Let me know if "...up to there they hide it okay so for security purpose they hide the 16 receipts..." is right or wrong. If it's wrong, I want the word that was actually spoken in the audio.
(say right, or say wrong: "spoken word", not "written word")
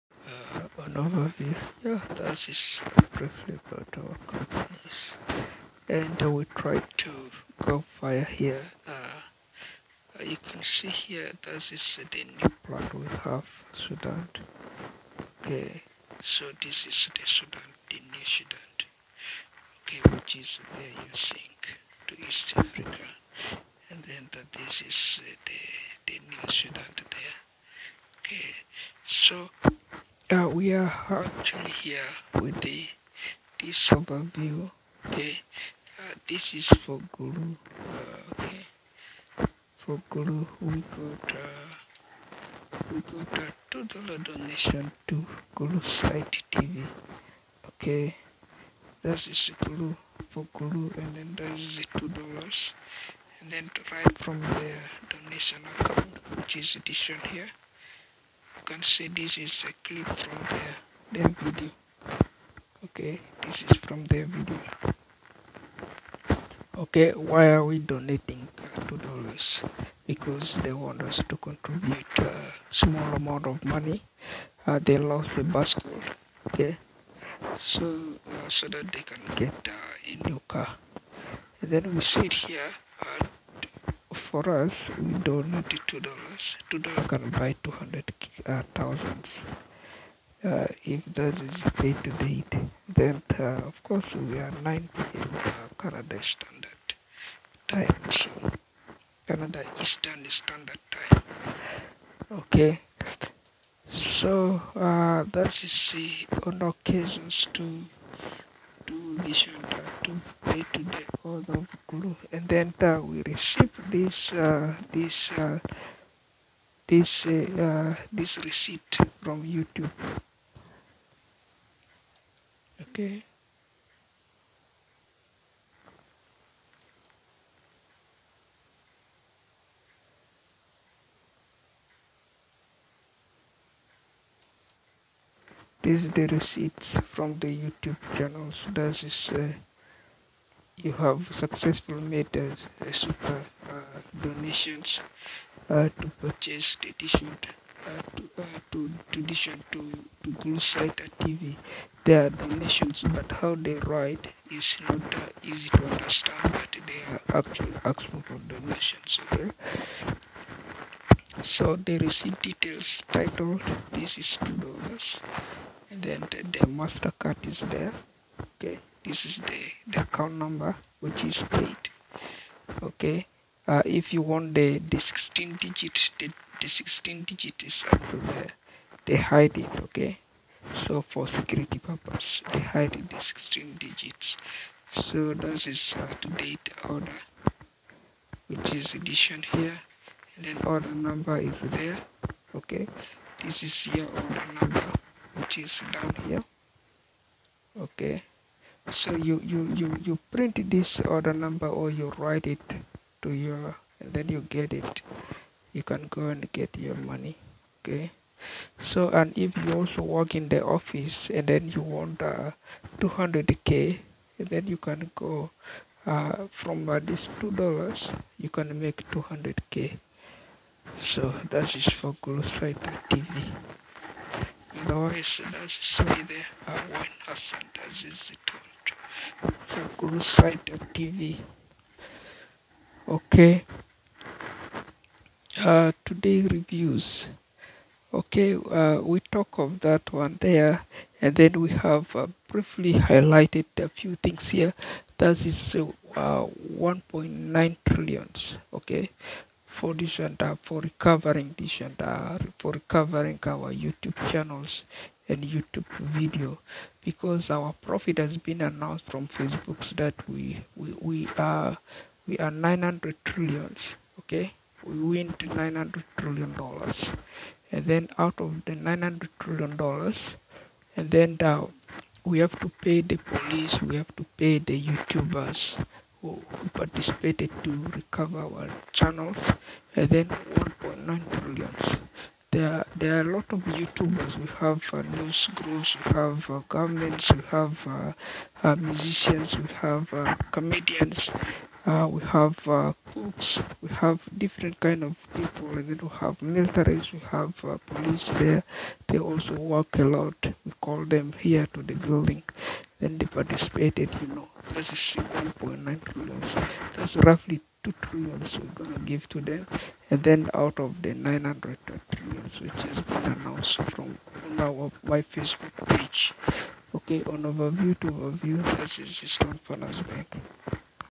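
wrong: "digits", not "receipts".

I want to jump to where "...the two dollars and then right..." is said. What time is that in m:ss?
0:51.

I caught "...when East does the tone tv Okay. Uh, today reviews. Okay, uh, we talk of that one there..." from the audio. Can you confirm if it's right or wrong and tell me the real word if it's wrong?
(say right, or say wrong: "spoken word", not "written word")
wrong: "Hassan", not "East".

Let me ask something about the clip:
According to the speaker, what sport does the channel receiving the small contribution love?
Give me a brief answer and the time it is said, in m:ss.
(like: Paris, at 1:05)
Basketball, at 1:15.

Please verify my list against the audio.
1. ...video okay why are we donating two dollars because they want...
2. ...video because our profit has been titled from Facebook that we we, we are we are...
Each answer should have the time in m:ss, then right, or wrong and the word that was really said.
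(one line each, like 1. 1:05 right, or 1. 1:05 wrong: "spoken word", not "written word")
1. 1:04 right
2. 4:16 wrong: "announced", not "titled".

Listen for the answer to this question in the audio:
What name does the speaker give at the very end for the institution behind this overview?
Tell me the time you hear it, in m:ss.
5:19.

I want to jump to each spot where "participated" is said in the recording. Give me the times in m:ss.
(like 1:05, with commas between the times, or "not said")
4:36, 5:03.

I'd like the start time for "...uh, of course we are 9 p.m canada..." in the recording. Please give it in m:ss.
1:33.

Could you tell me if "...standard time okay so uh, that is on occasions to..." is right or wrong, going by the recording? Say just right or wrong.
right.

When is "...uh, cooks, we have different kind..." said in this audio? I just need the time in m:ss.
4:52.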